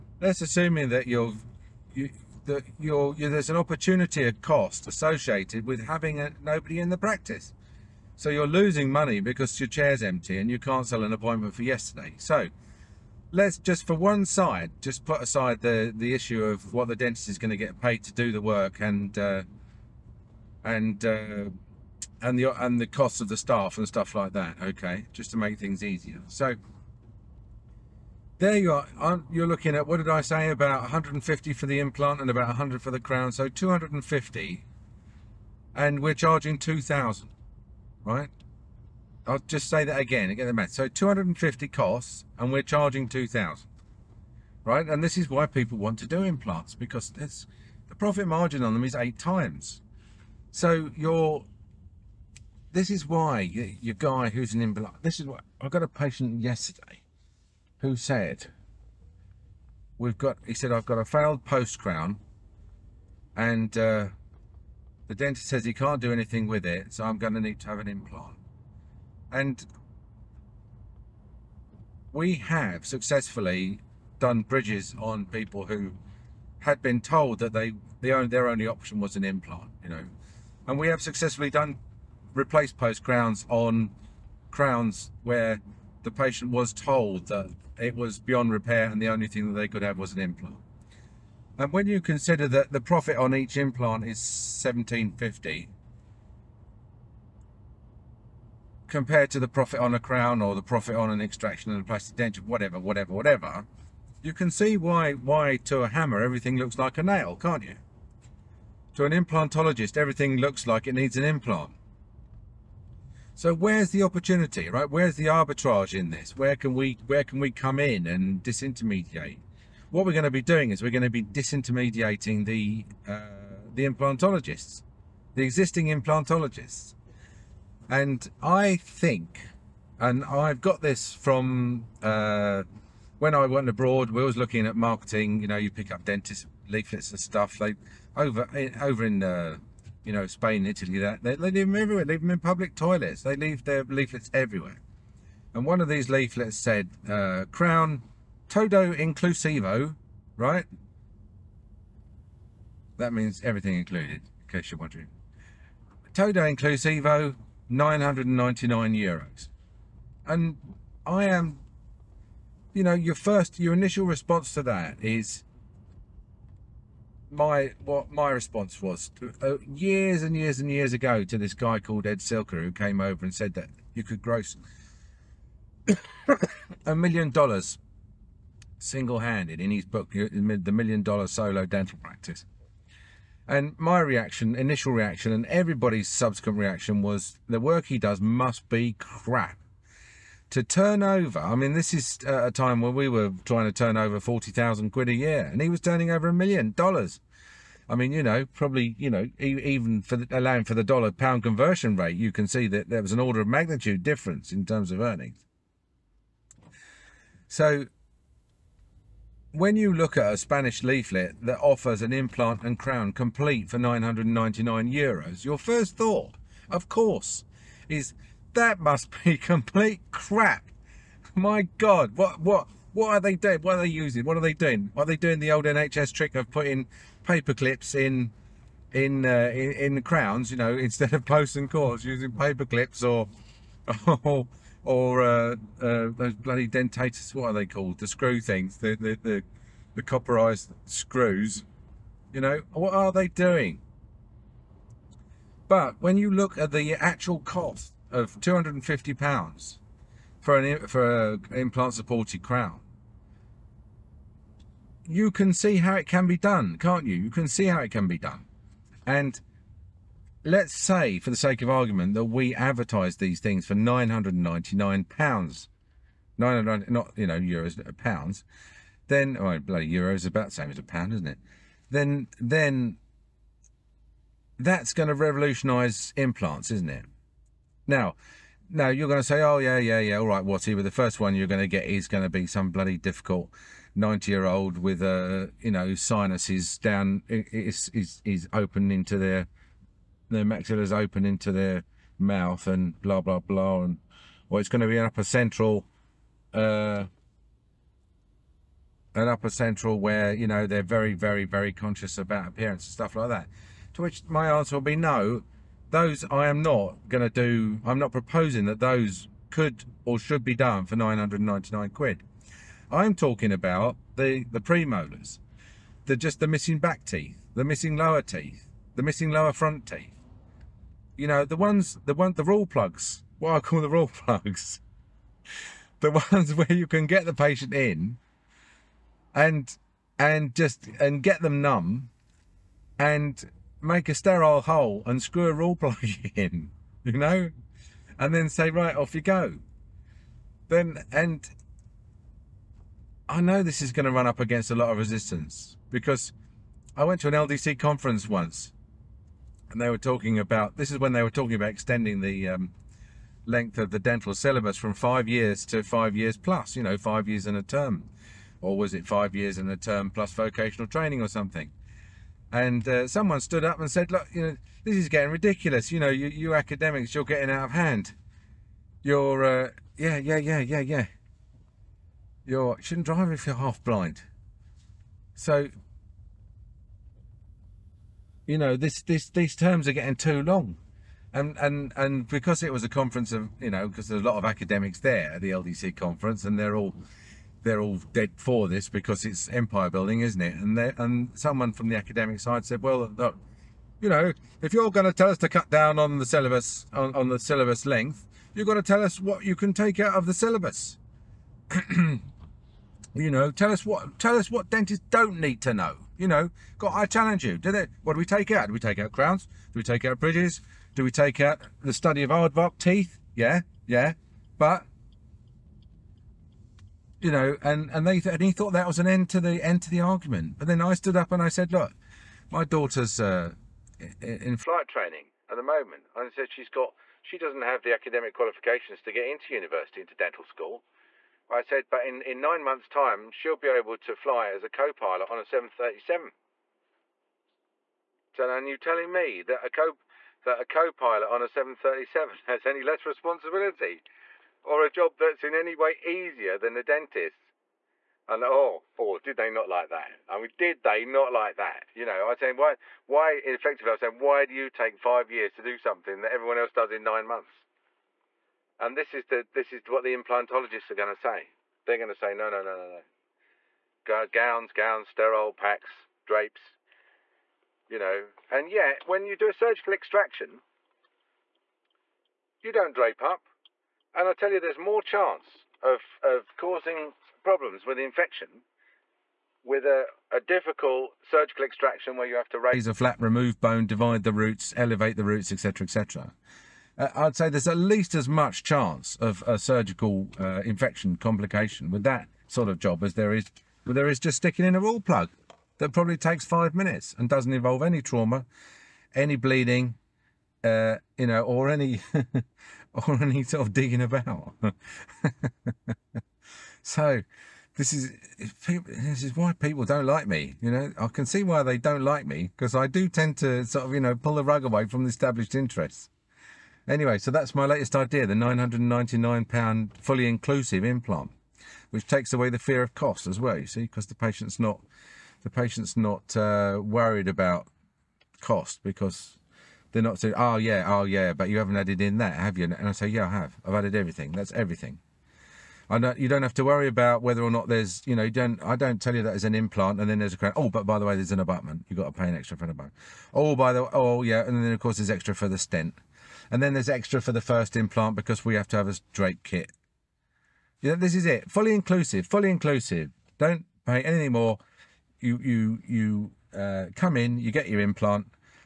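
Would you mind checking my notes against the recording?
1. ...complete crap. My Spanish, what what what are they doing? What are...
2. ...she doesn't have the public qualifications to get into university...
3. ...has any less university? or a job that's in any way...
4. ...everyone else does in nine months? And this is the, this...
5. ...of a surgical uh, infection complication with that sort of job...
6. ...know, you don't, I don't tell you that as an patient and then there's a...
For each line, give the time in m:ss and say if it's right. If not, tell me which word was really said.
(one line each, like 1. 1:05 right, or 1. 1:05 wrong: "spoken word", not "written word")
1. 3:39 wrong: "God", not "Spanish"
2. 7:07 wrong: "academic", not "public"
3. 7:22 wrong: "responsibility", not "university"
4. 7:36 right
5. 8:09 right
6. 8:58 wrong: "implant", not "patient".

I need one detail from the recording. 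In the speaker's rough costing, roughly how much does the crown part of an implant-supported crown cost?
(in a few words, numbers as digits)
100.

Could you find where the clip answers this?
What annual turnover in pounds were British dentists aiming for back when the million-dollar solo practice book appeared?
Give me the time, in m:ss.
3:14.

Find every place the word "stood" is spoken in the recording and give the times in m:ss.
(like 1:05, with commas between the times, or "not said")
6:03, 7:00.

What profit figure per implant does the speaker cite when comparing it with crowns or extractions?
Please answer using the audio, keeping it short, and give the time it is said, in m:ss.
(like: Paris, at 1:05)
1750, at 1:34.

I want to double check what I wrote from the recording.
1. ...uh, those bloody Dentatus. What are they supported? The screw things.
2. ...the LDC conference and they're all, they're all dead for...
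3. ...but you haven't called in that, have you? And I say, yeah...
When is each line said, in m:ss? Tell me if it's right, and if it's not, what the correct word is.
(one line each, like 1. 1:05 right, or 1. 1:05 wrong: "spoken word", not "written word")
1. 3:55 wrong: "called", not "supported"
2. 6:25 right
3. 8:51 wrong: "added", not "called".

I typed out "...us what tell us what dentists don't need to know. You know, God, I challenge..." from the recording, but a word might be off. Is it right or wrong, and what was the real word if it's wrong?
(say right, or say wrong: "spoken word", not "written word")
right.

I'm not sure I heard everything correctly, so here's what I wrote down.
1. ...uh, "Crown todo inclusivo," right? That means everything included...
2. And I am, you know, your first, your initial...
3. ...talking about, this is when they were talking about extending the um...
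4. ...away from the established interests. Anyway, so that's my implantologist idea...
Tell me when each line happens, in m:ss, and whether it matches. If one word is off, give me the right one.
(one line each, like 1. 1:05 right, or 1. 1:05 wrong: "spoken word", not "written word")
1. 2:27 right
2. 2:40 right
3. 5:49 right
4. 8:34 wrong: "latest", not "implantologist".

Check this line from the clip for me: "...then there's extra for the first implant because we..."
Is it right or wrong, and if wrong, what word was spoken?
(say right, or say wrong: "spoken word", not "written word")
right.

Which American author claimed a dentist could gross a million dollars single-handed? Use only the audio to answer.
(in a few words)
Ed Silker.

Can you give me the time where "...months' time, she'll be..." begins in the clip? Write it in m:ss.
7:12.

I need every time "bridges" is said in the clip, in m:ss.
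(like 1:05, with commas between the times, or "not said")
1:14, 6:50.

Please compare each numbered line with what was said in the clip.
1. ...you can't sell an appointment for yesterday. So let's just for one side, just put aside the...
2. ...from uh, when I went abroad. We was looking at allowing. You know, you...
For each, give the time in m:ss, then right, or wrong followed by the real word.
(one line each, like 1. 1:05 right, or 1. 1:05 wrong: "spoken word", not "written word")
1. 0:10 right
2. 2:11 wrong: "marketing", not "allowing".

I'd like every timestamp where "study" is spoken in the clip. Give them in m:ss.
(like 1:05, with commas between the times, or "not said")
6:51.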